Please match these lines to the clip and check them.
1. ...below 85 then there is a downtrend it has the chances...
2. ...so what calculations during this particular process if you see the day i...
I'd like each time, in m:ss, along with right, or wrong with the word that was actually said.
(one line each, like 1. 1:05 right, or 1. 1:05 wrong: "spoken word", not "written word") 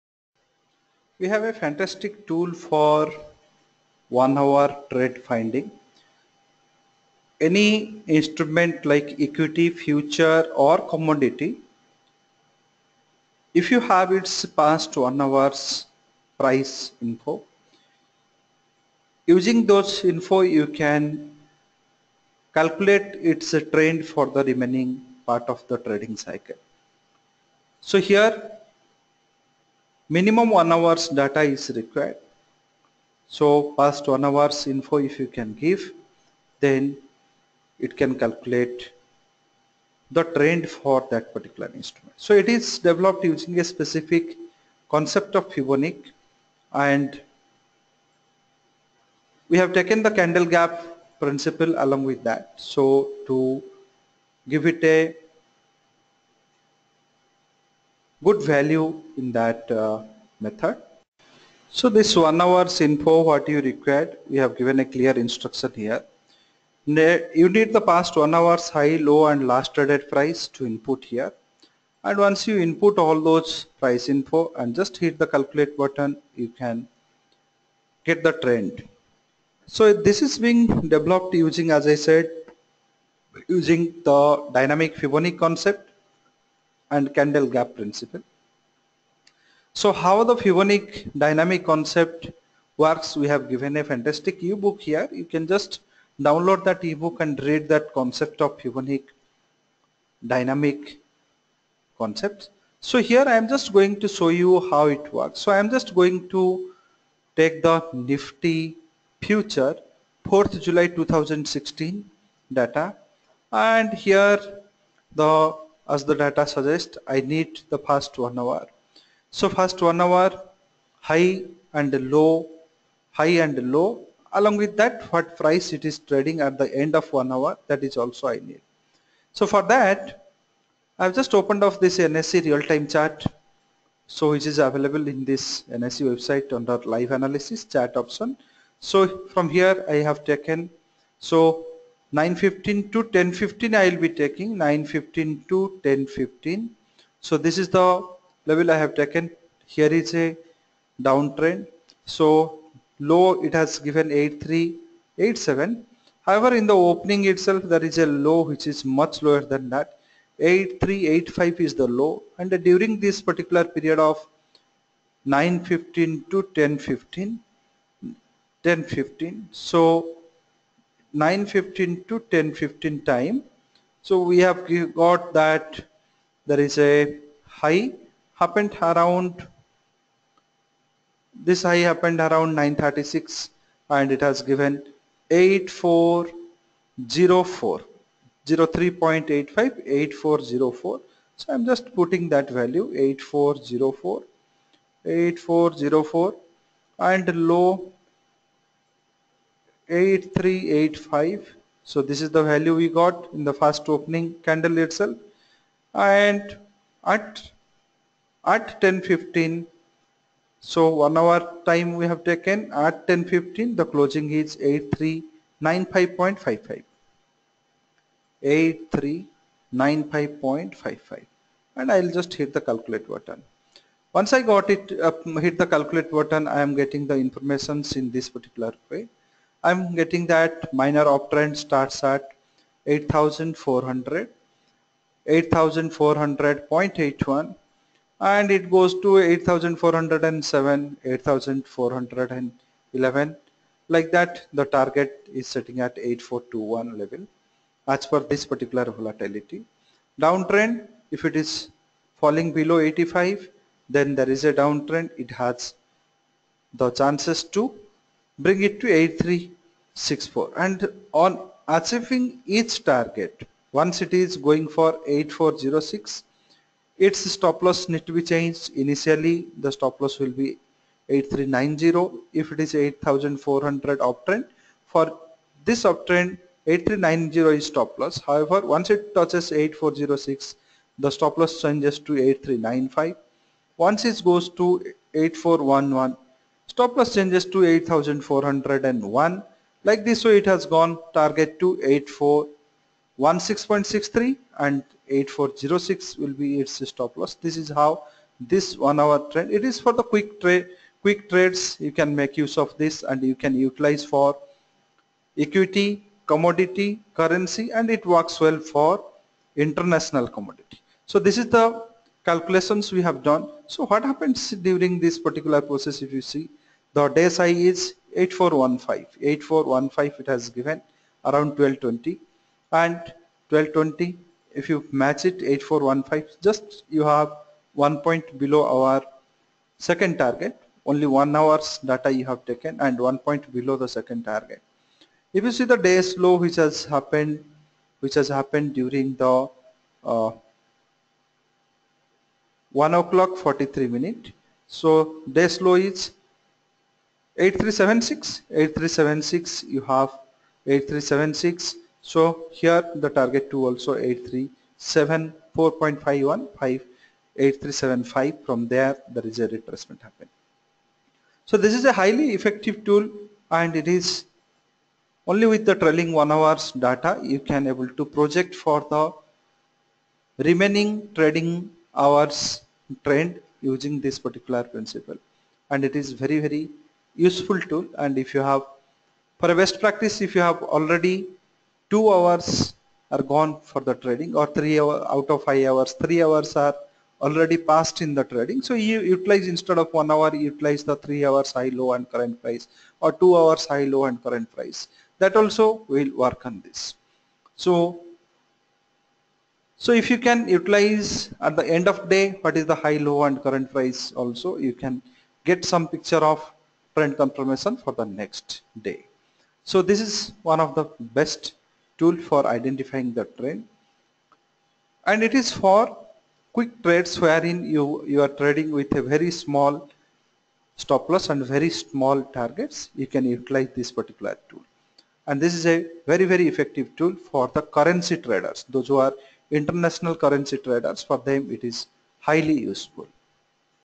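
1. 4:12 right
2. 5:13 wrong: "happens", not "calculations".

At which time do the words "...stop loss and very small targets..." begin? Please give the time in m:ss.
7:00.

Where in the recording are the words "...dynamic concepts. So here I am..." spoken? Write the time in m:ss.
1:40.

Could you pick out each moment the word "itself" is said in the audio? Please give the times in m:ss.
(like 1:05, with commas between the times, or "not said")
2:37, 3:24.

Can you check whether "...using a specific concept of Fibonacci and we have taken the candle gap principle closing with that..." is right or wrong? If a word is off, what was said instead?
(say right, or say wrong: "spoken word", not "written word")
wrong: "along", not "closing".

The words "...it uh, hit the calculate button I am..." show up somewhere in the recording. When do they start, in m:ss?
3:44.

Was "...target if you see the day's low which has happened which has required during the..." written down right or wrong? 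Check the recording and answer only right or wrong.
wrong.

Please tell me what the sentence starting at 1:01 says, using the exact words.
So this one hours info what you required we have given a clear instruction here.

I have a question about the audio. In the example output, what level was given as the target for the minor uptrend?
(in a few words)
8421.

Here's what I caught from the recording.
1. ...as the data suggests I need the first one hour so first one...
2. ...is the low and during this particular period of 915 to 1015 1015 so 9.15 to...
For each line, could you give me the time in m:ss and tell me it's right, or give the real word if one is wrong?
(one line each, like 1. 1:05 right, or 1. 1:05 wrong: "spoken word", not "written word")
1. 1:55 right
2. 2:41 right.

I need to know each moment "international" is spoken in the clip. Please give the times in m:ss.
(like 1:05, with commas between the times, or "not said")
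5:09, 7:09.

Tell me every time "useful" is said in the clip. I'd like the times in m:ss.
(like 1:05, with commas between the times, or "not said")
6:17, 7:12.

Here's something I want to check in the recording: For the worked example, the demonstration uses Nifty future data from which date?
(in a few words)
4th July 2016.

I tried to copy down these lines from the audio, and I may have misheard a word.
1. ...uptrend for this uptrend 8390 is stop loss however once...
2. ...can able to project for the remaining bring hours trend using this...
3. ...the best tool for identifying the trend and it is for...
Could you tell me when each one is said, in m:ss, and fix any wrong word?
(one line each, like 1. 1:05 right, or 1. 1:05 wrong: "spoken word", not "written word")
1. 4:34 right
2. 6:07 wrong: "trading", not "bring"
3. 6:50 right.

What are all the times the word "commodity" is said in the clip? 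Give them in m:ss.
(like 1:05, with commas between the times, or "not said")
0:10, 5:06, 5:10.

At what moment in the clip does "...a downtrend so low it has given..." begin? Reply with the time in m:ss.
2:30.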